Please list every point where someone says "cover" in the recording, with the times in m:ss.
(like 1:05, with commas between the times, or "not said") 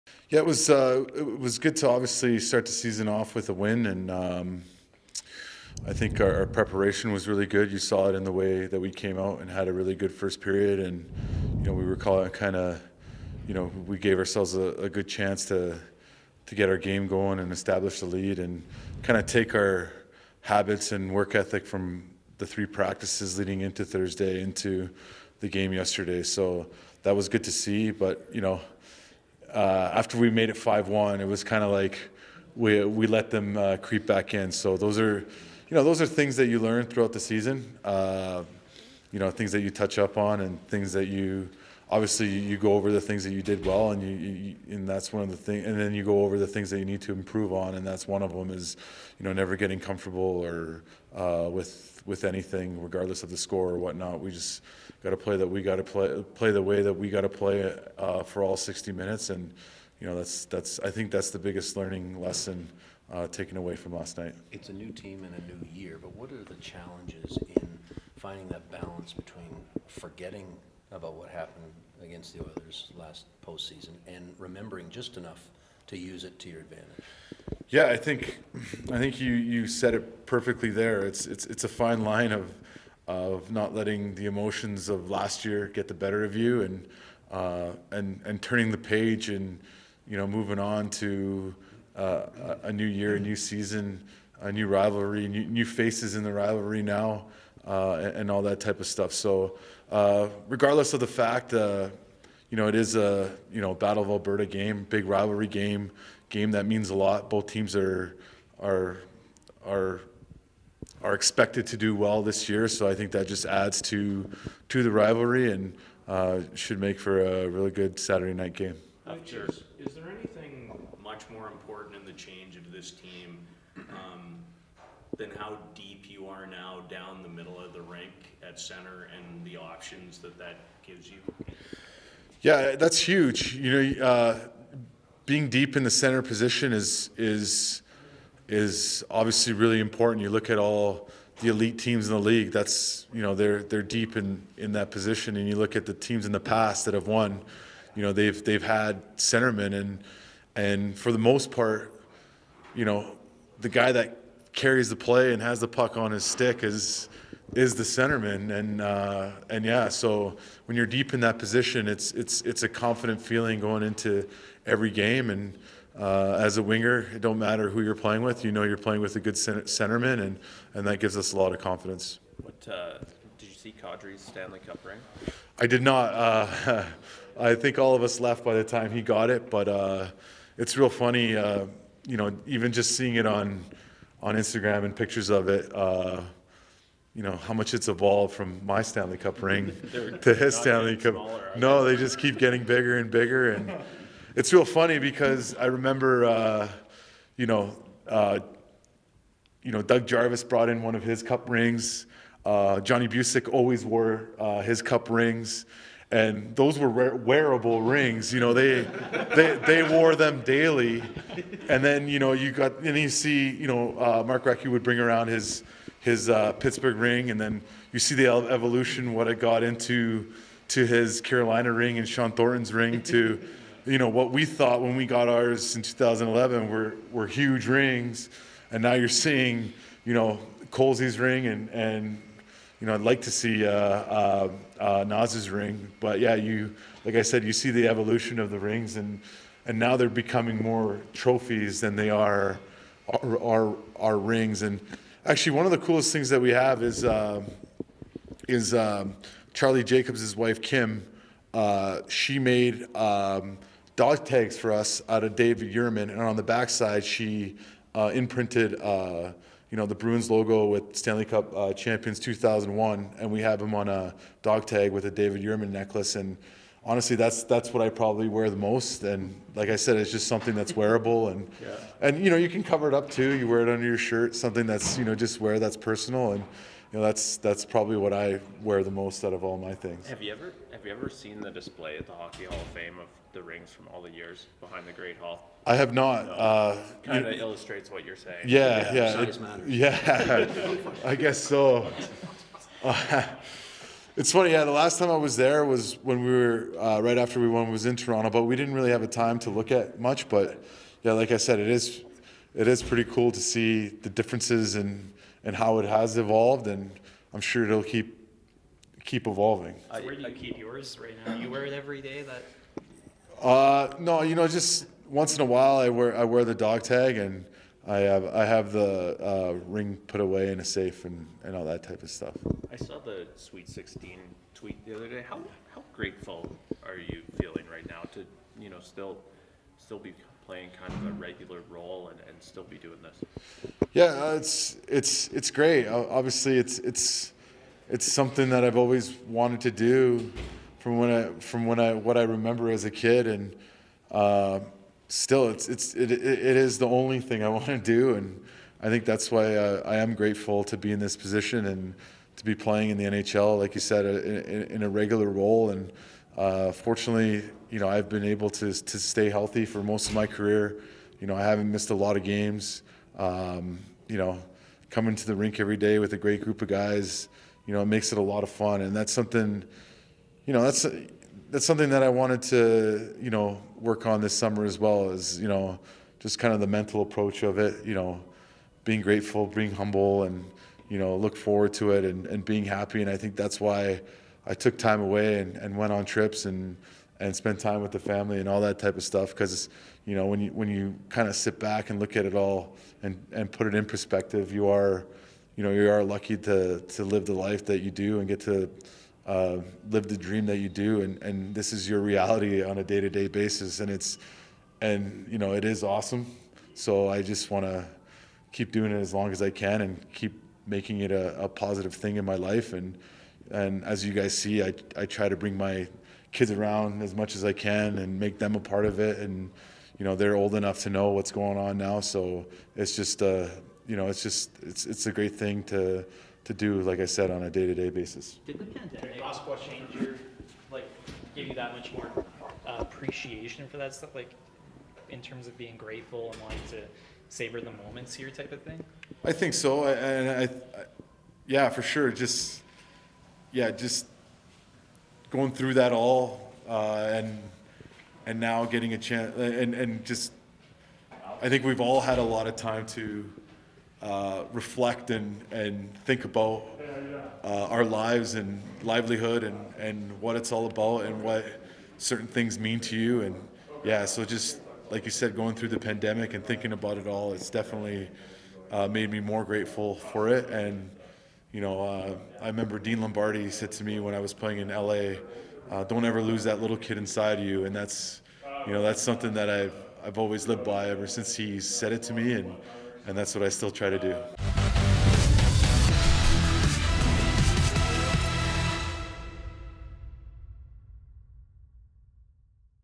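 4:32.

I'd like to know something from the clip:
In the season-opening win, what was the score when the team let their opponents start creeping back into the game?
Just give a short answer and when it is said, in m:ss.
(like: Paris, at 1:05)
5-1, at 0:30.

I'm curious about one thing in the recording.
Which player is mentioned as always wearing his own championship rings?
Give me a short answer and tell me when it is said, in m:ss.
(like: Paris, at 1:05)
Johnny Bucyk, at 3:22.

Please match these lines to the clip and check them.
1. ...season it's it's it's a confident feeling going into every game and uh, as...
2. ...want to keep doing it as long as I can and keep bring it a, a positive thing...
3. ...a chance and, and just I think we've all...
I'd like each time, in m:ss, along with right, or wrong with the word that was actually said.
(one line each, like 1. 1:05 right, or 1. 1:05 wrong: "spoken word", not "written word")
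1. 2:41 wrong: "position", not "season"
2. 6:47 wrong: "making", not "bring"
3. 7:28 right.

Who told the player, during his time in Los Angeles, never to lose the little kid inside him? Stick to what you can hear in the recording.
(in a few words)
Dean Lombardi.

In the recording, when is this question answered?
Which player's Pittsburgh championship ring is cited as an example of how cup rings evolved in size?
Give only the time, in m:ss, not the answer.
3:34.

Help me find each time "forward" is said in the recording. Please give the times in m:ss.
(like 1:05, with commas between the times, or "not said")
6:21.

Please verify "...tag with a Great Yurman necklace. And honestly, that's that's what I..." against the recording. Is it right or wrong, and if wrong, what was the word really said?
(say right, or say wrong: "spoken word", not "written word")
wrong: "David", not "Great".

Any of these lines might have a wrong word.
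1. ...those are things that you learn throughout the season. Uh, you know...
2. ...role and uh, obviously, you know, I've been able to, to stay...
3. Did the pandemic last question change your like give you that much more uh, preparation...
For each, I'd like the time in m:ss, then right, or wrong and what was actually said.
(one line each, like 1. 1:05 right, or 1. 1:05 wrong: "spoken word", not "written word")
1. 0:35 right
2. 5:55 wrong: "fortunately", not "obviously"
3. 7:08 wrong: "appreciation", not "preparation".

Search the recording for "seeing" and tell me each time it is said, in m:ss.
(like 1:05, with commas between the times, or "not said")
3:02, 3:49.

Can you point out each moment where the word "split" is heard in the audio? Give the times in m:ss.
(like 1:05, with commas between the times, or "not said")
not said.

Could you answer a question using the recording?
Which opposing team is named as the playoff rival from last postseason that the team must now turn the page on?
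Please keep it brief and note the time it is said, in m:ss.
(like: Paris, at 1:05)
Oilers, at 1:12.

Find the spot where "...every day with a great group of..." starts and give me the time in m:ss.
6:05.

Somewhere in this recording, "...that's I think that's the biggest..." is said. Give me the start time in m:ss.
1:00.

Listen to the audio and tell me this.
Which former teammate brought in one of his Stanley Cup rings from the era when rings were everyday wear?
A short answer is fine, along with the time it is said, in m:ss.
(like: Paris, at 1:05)
Doug Jarvis, at 3:19.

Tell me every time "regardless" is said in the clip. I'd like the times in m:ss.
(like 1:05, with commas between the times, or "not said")
0:52, 1:40.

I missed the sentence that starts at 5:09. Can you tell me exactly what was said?
So where do you keep yours right now?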